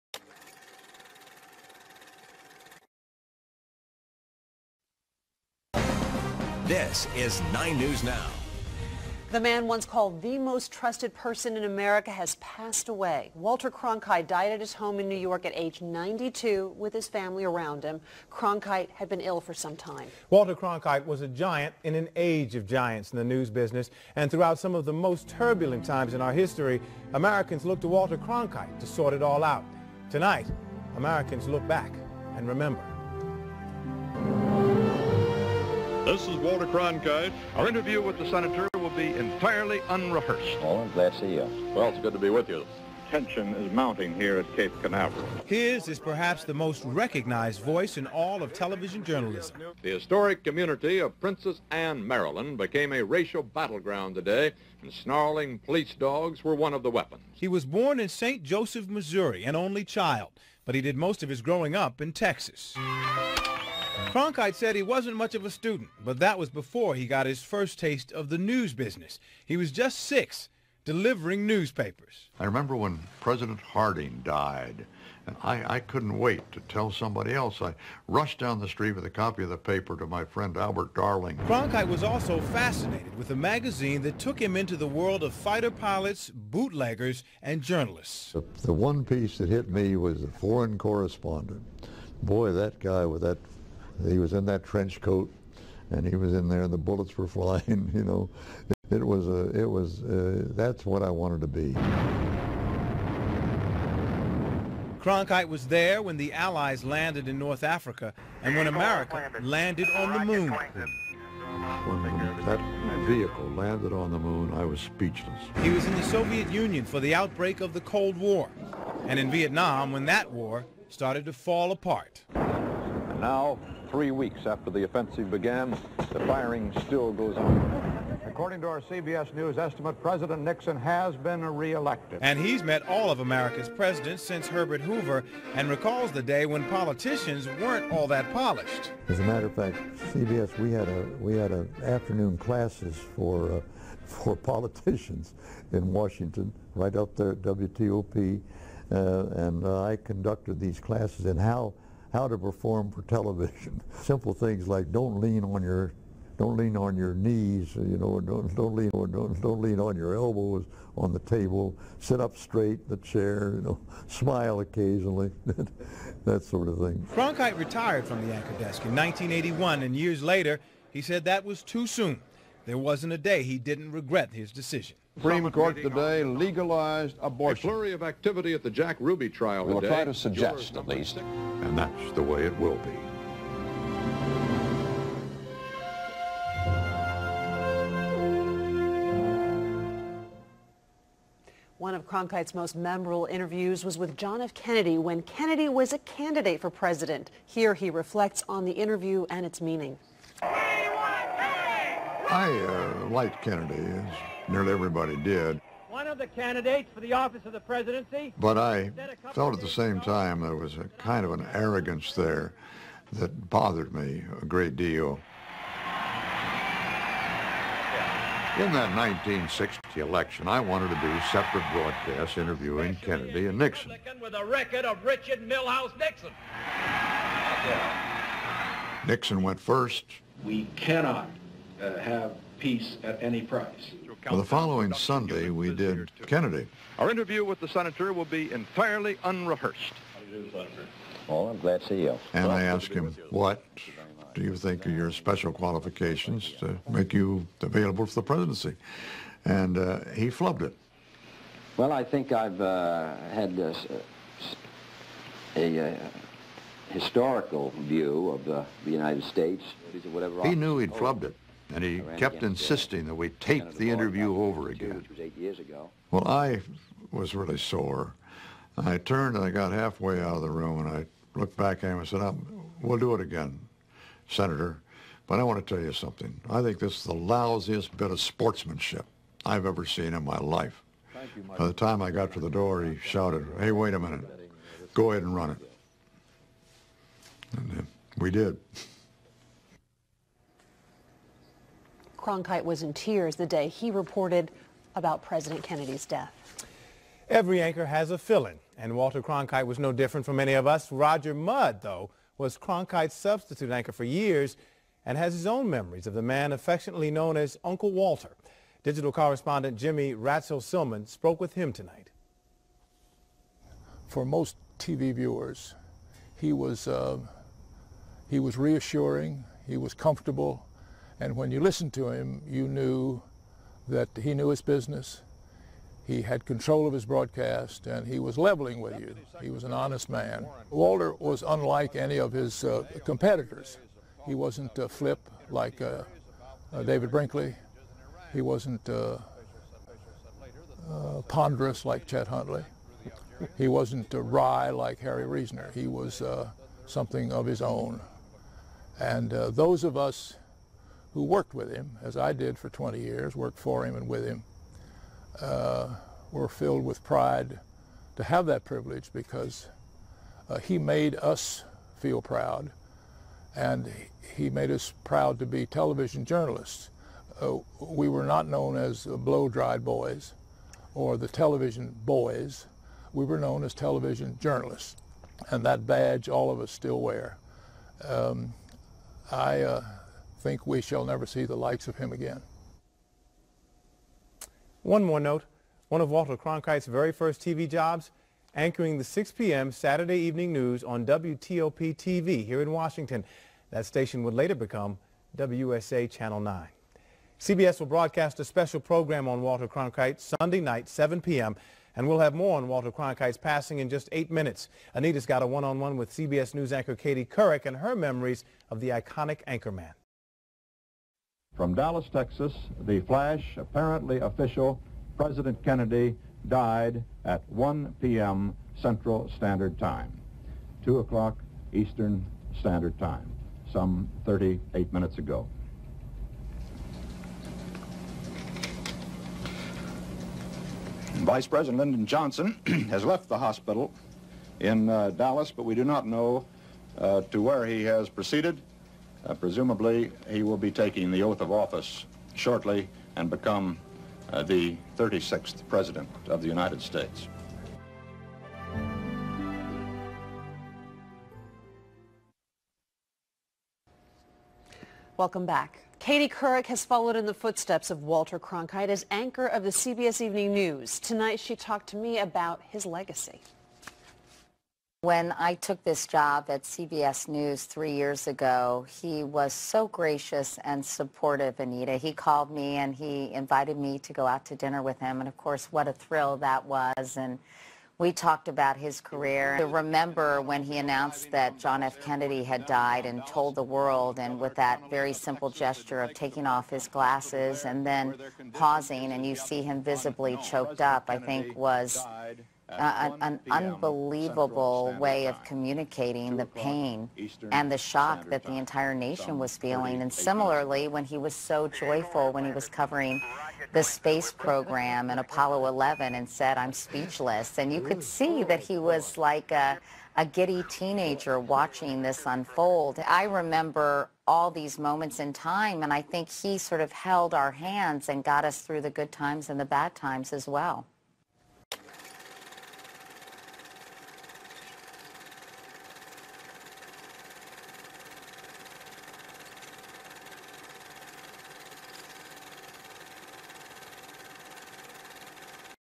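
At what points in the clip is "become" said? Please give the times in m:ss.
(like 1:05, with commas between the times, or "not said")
6:34, 7:23.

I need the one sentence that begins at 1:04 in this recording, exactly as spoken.
Cronkite said he wasn't much of a student, but that was before he got his first taste of the news business.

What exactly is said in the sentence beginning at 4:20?
He knew he'd flubbed it and he kept uh, insisting that we tape the interview over again.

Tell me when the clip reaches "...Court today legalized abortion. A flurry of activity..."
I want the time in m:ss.
2:55.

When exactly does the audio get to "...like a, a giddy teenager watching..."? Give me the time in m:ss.
8:29.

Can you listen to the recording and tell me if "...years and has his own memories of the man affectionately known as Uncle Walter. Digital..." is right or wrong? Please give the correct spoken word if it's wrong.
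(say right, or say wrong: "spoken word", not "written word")
right.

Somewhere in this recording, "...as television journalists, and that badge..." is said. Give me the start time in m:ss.
6:13.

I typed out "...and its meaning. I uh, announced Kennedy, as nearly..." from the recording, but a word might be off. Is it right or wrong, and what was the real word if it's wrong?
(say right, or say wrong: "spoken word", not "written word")
wrong: "liked", not "announced".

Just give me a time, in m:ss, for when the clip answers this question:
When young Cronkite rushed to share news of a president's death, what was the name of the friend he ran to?
1:20.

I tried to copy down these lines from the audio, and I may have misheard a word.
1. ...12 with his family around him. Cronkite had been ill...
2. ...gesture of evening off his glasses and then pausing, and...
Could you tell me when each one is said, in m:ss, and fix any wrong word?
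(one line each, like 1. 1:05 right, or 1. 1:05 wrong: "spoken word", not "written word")
1. 0:15 wrong: "92", not "12"
2. 8:05 wrong: "taking", not "evening".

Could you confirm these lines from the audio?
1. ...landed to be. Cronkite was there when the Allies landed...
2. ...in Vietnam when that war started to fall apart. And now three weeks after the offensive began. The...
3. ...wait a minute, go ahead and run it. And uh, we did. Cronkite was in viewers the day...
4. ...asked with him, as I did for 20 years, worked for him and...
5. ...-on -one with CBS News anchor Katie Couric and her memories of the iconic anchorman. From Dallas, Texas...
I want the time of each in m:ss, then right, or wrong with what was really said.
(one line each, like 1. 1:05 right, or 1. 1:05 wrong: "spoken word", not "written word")
1. 1:41 wrong: "wanted", not "landed"
2. 1:59 right
3. 4:43 wrong: "tears", not "viewers"
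4. 5:51 wrong: "worked", not "asked"
5. 6:45 right.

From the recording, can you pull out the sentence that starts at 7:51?
He called me and he invited me to go out to dinner with him.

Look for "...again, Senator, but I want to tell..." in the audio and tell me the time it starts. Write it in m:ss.
4:33.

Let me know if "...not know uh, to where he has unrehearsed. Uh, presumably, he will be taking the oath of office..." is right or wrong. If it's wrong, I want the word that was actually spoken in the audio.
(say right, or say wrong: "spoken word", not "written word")
wrong: "proceeded", not "unrehearsed".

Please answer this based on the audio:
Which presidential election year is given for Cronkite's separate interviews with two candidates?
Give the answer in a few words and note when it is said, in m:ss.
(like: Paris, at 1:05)
1960, at 3:38.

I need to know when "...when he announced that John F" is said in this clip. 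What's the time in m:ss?
8:00.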